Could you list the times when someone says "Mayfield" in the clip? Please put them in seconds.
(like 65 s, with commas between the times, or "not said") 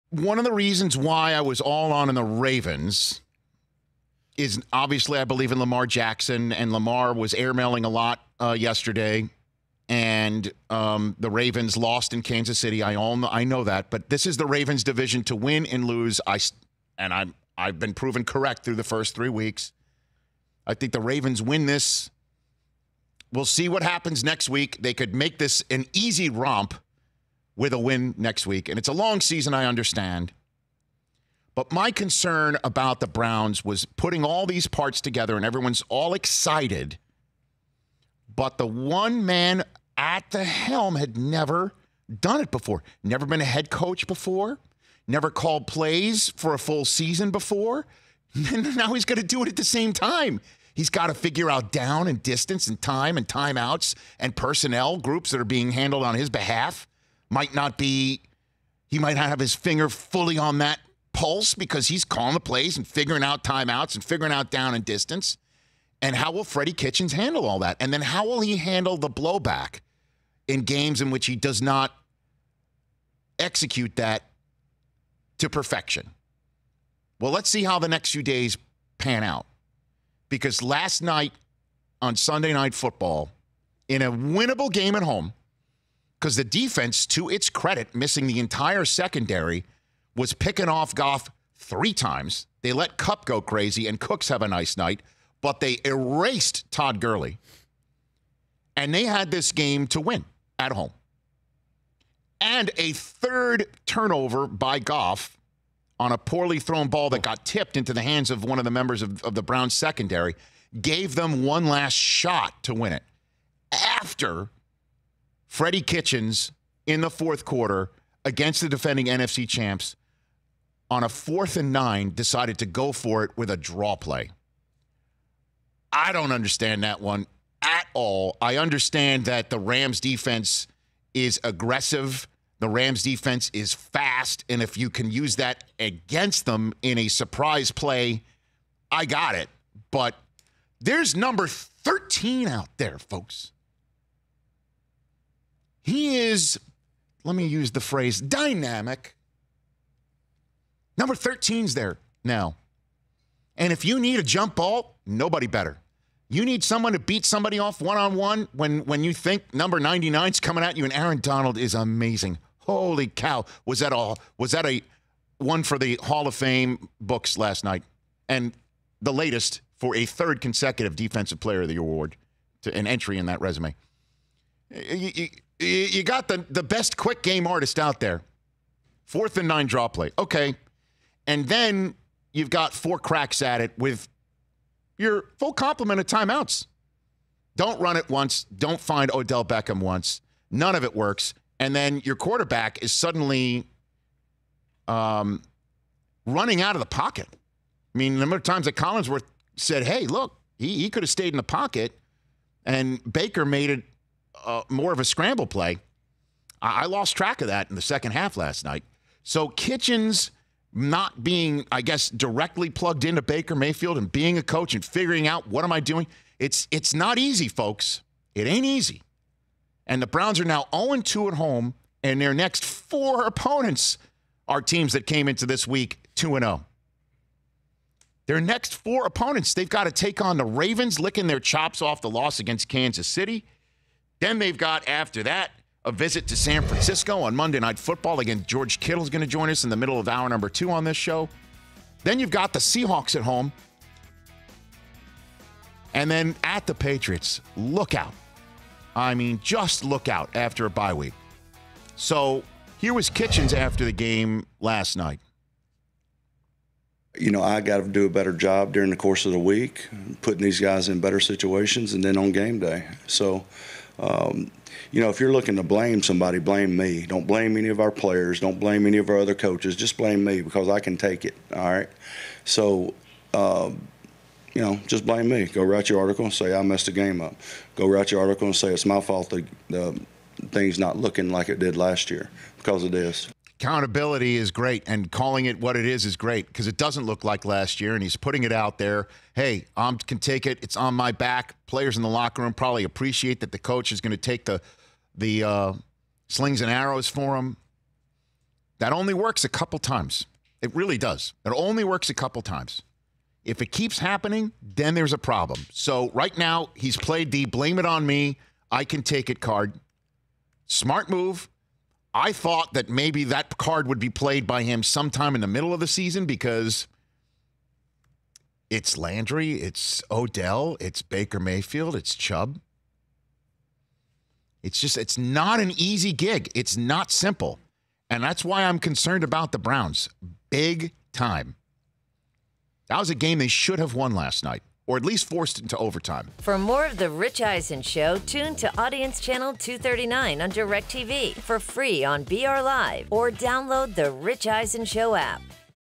213 s, 321 s.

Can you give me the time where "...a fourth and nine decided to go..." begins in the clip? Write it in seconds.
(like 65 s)
121 s.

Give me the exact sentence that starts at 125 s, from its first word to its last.
I don't understand that one at all.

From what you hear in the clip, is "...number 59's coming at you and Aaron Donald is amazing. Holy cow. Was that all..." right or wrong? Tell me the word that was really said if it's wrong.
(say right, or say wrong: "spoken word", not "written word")
wrong: "99", not "59".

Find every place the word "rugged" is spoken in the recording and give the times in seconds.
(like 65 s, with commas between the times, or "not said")
not said.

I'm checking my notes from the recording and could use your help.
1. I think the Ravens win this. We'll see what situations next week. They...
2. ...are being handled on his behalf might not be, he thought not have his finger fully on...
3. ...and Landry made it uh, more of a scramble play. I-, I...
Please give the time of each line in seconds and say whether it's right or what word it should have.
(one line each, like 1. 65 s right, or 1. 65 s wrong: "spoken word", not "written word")
1. 20 s wrong: "happens", not "situations"
2. 55 s wrong: "might", not "thought"
3. 202 s wrong: "Baker", not "Landry".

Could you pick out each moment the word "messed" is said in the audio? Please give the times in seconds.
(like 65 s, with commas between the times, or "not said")
276 s.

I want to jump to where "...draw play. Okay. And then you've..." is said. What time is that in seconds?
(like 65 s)
179 s.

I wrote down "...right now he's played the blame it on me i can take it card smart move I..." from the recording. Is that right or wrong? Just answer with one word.
right.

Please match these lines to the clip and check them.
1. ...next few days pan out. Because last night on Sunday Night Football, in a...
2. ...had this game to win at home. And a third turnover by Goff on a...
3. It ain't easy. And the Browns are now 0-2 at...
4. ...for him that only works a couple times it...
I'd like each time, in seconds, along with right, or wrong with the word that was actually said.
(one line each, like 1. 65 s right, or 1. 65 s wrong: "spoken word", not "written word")
1. 77 s right
2. 99 s right
3. 218 s right
4. 297 s right.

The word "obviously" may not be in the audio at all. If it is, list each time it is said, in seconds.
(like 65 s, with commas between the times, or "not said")
4 s.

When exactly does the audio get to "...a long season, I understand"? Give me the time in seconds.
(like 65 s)
28 s.